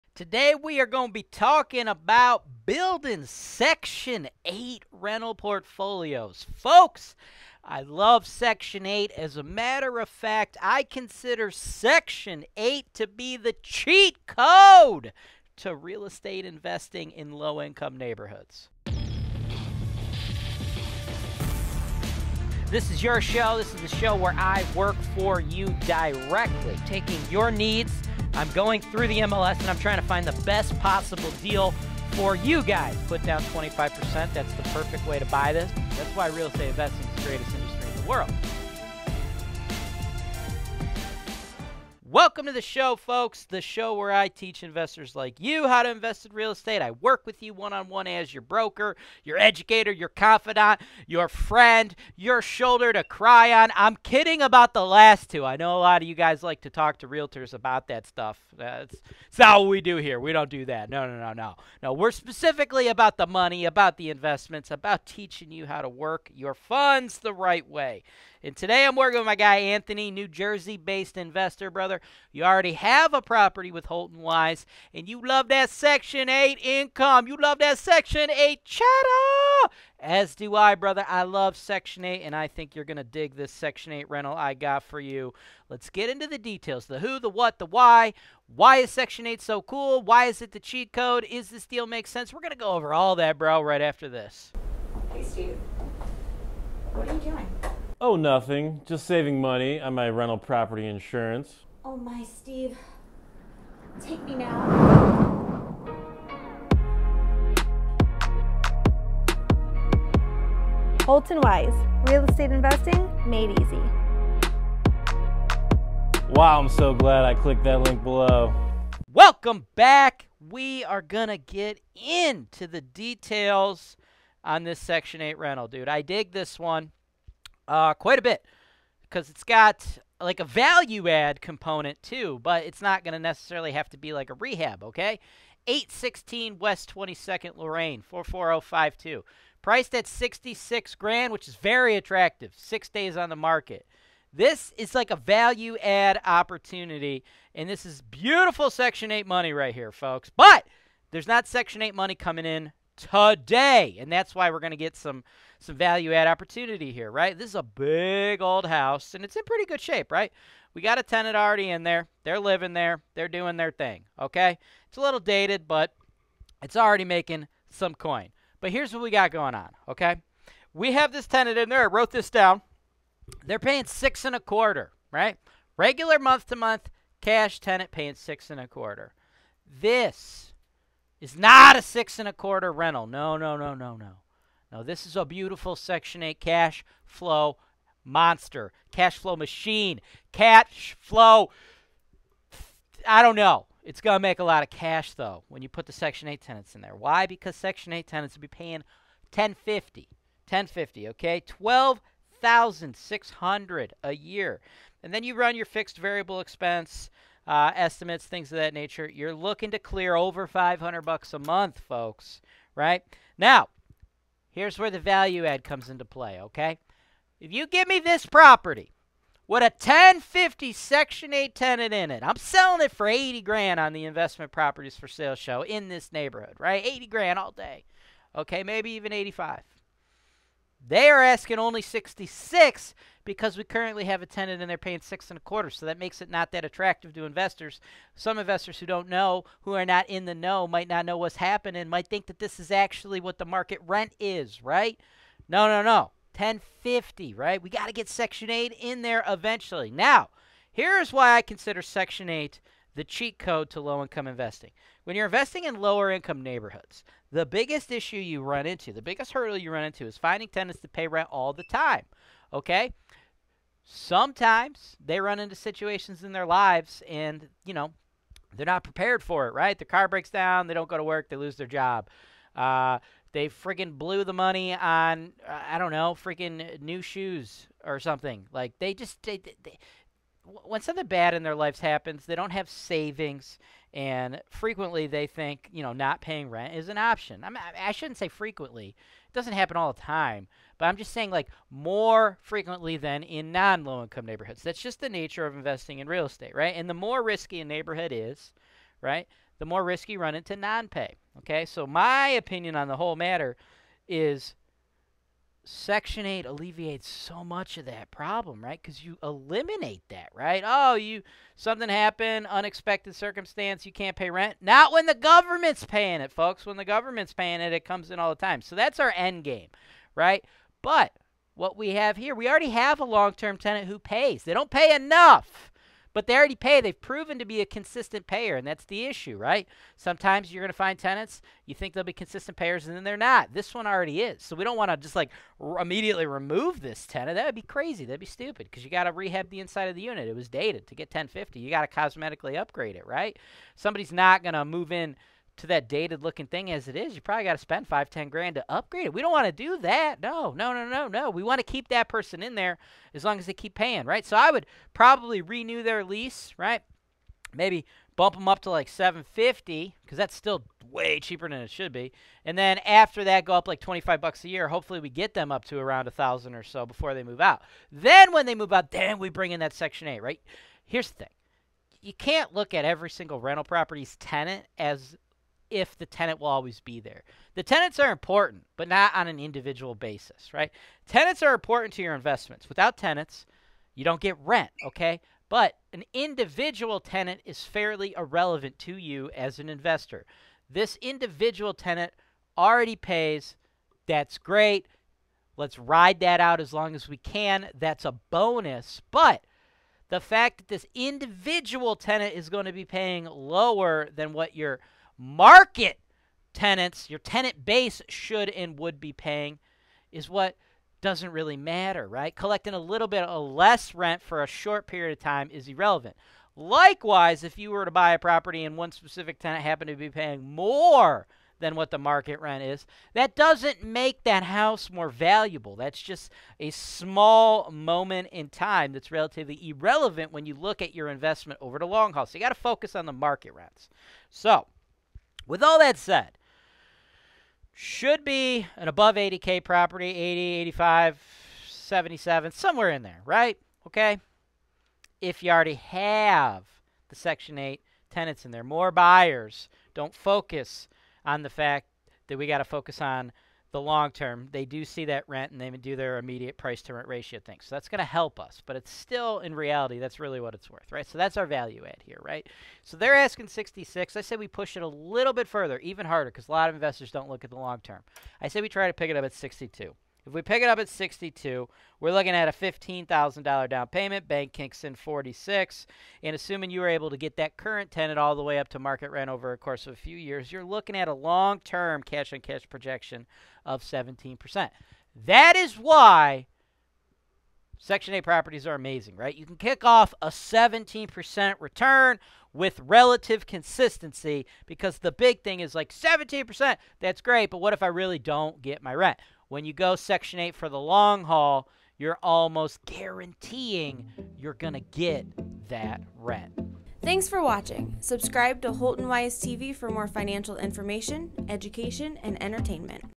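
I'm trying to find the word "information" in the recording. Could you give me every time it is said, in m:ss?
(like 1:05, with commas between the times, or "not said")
8:30.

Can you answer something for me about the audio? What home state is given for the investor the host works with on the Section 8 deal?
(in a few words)
New Jersey.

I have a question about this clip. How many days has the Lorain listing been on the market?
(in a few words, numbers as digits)
6.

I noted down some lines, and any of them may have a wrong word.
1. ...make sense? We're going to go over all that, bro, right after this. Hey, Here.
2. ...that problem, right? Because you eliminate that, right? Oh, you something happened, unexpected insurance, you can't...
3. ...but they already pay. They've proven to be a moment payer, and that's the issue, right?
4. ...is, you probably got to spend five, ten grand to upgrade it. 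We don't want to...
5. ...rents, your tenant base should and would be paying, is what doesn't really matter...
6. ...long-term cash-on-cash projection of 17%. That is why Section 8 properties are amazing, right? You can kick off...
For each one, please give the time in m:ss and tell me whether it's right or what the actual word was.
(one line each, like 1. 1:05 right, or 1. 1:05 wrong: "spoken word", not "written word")
1. 1:31 wrong: "Steve", not "Here"
2. 5:07 wrong: "circumstance", not "insurance"
3. 5:26 wrong: "consistent", not "moment"
4. 5:46 right
5. 6:46 wrong: "tenants", not "rents"
6. 8:01 right.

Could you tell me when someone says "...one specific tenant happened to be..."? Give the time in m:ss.
6:58.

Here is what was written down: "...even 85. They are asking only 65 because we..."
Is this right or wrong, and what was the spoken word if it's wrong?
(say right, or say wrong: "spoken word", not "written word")
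wrong: "66", not "65".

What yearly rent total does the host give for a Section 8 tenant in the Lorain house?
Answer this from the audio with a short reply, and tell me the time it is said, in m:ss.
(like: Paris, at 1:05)
12,600, at 3:21.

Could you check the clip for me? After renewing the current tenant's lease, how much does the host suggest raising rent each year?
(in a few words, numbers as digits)
$25.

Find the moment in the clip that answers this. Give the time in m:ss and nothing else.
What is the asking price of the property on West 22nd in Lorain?
2:20.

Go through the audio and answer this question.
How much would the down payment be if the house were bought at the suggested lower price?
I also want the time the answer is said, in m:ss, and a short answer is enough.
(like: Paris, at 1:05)
$15,000, at 7:52.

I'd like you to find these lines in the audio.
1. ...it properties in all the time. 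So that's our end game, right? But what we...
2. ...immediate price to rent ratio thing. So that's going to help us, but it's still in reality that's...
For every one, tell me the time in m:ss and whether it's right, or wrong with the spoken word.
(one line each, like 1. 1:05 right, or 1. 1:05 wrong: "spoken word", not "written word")
1. 5:17 wrong: "comes", not "properties"
2. 7:36 right.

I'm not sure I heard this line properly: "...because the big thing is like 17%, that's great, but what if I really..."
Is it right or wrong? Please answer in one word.
right.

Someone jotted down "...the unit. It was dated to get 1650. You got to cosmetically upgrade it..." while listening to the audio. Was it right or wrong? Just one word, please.
wrong.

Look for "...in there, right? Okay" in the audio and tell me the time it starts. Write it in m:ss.
7:22.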